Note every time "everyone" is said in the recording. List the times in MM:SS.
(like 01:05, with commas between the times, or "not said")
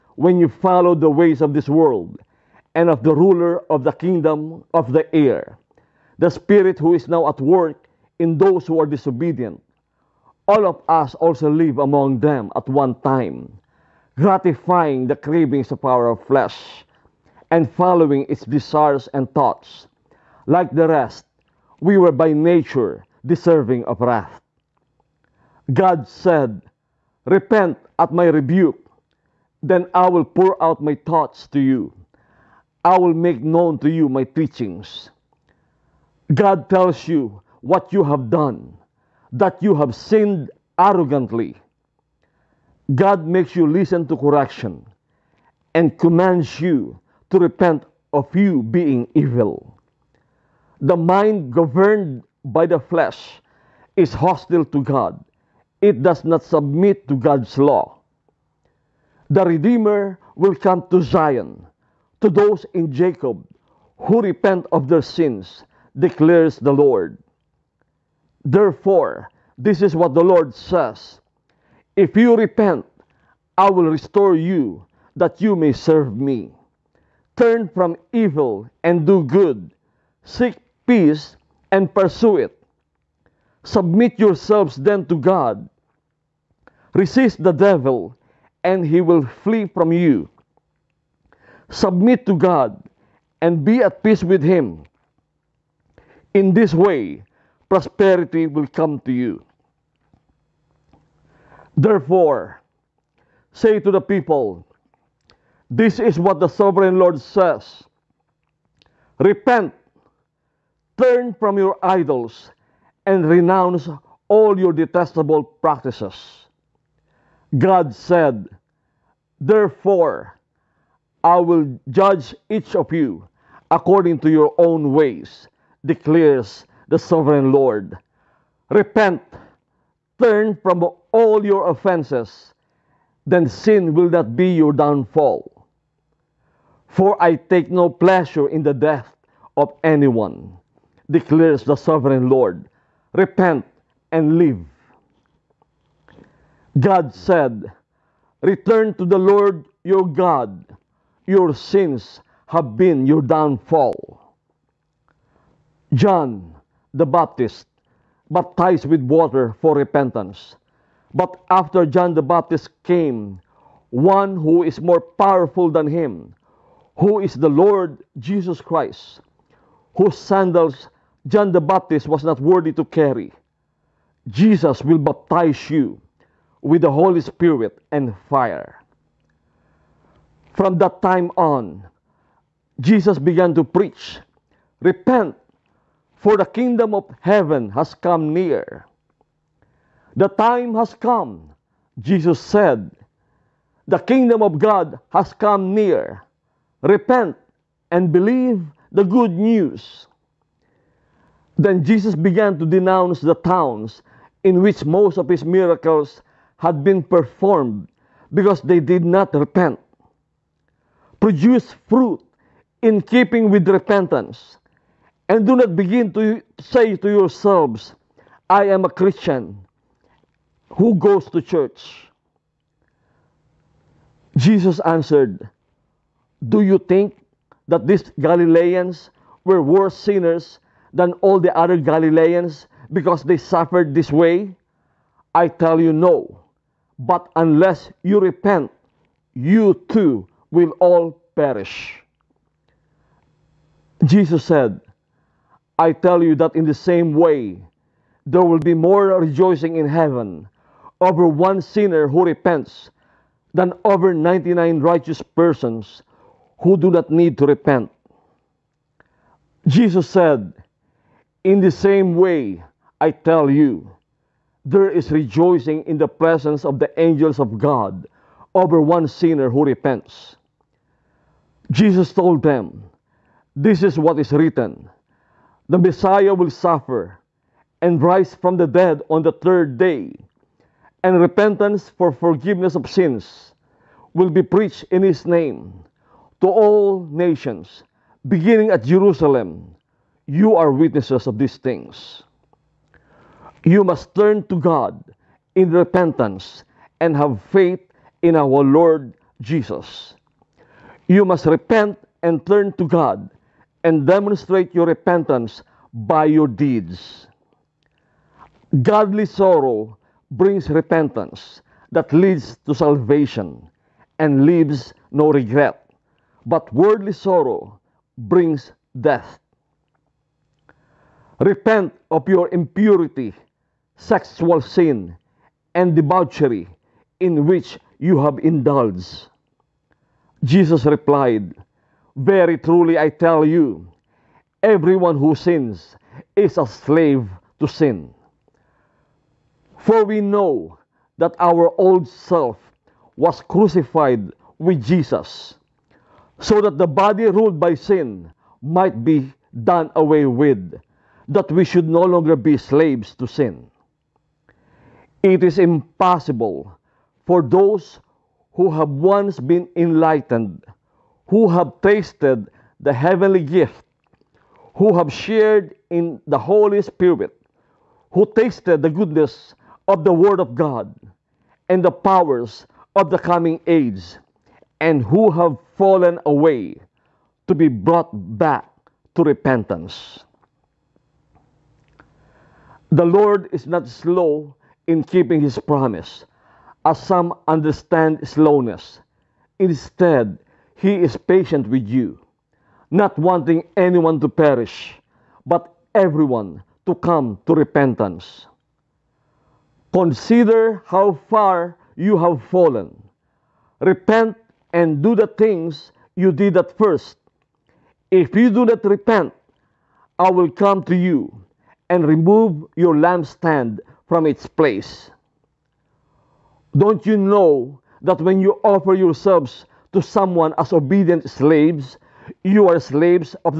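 05:34, 06:35.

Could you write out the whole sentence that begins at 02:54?
Jesus will baptize you with the Holy Spirit and fire.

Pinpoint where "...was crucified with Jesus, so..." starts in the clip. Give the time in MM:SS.
05:43.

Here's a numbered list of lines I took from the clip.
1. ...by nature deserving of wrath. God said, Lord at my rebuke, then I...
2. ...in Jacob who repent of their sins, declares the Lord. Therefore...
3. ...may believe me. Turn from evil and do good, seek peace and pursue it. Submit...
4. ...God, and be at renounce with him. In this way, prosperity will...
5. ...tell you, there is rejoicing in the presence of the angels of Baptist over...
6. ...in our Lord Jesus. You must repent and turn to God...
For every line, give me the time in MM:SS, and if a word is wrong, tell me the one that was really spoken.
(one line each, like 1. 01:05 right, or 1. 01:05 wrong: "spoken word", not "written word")
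1. 00:22 wrong: "Repent", not "Lord"
2. 01:02 right
3. 01:15 wrong: "serve", not "believe"
4. 01:32 wrong: "peace", not "renounce"
5. 04:23 wrong: "God", not "Baptist"
6. 04:58 right.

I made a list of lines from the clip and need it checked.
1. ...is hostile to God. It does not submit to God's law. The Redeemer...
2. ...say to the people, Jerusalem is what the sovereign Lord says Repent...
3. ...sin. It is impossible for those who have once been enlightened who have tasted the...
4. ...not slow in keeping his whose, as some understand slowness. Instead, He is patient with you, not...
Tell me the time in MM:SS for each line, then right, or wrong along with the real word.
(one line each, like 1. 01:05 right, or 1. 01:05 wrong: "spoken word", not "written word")
1. 00:53 right
2. 01:43 wrong: "This", not "Jerusalem"
3. 05:53 right
4. 06:23 wrong: "promise", not "whose".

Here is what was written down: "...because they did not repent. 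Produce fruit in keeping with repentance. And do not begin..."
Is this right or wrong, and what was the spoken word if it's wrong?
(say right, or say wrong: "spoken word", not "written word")
right.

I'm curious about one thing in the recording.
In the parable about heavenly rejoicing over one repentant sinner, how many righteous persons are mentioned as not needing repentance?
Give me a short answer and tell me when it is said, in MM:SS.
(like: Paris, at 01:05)
99, at 04:14.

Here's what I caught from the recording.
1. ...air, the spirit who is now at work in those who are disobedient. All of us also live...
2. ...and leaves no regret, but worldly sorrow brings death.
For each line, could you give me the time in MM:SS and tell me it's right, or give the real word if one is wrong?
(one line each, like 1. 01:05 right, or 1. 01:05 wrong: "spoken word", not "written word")
1. 00:05 right
2. 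05:14 right.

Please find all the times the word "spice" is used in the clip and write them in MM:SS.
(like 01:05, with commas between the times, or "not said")
not said.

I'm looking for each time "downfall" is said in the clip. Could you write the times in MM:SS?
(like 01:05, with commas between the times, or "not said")
02:14, 02:33.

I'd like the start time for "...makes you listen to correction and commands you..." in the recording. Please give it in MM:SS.
00:43.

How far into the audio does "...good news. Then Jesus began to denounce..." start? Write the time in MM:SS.
03:19.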